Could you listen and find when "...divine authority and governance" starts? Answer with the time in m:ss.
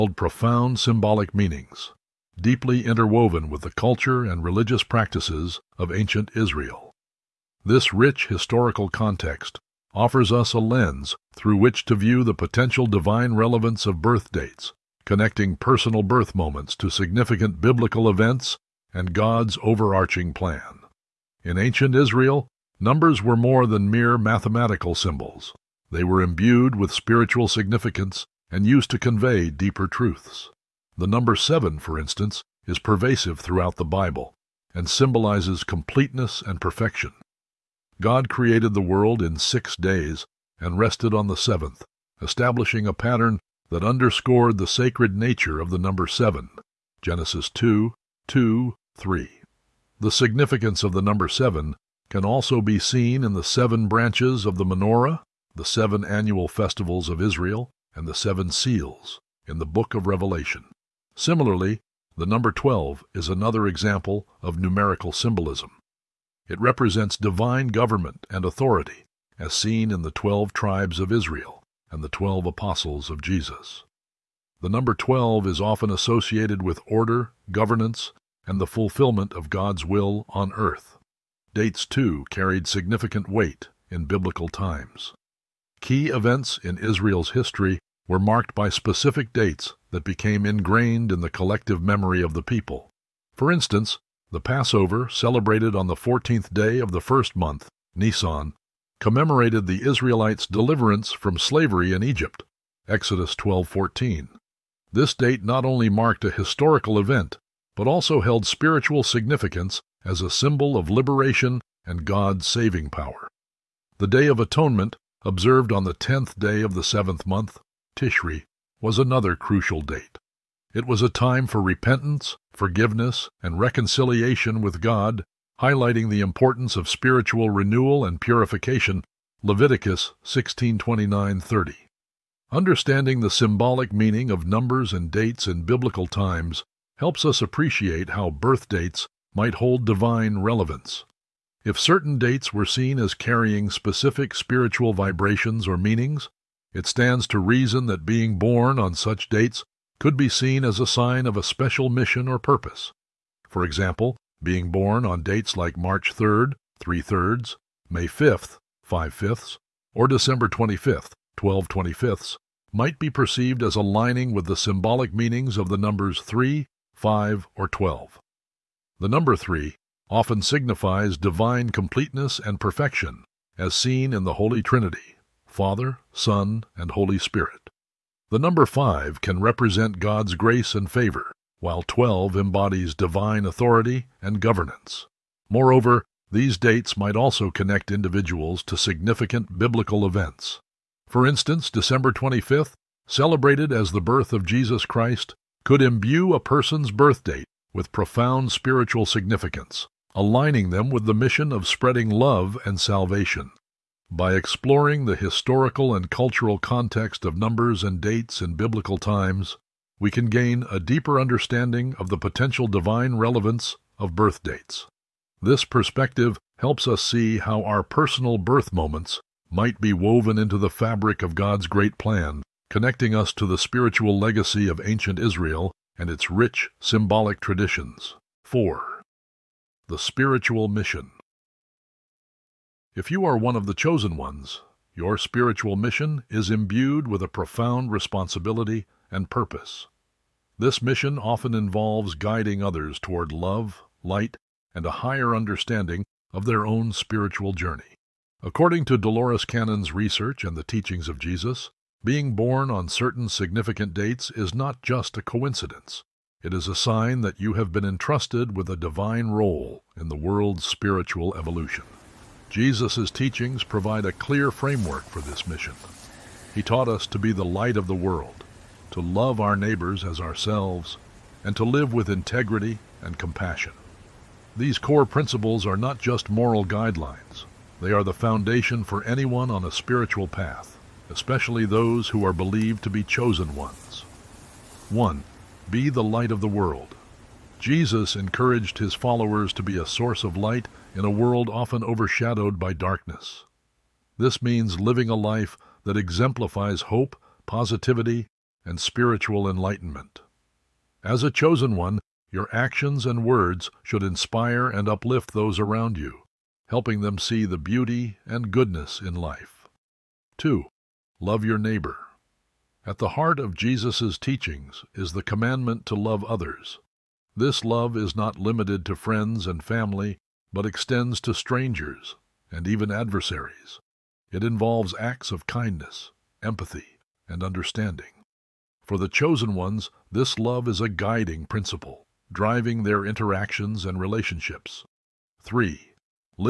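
3:02.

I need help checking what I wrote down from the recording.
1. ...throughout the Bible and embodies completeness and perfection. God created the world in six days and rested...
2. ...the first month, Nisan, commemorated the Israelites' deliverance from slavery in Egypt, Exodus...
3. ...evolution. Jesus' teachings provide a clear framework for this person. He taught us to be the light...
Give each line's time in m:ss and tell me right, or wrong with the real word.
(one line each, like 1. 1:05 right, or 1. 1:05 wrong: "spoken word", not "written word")
1. 0:33 wrong: "symbolizes", not "embodies"
2. 1:36 right
3. 4:21 wrong: "mission", not "person".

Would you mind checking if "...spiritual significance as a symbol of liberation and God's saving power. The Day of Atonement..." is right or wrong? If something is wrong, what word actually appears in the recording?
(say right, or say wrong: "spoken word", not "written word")
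right.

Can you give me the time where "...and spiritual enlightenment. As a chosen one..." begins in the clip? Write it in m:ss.
4:58.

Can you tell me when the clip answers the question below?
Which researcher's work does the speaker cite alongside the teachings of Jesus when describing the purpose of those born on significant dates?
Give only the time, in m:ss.
4:08.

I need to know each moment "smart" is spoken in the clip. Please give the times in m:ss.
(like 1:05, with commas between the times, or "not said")
not said.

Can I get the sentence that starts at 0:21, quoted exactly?
In ancient Israel, numbers were more than mere mathematical symbols.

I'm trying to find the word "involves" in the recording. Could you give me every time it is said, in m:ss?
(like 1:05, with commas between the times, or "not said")
4:01, 5:24.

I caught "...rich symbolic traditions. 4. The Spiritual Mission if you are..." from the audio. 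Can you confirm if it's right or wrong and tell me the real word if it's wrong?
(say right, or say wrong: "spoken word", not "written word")
right.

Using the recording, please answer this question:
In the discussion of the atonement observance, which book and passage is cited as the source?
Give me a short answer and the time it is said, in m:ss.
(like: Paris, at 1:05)
Leviticus 16:29-30, at 2:09.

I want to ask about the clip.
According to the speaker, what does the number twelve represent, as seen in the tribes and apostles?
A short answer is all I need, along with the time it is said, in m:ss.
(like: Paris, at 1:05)
divine government and authority, at 1:07.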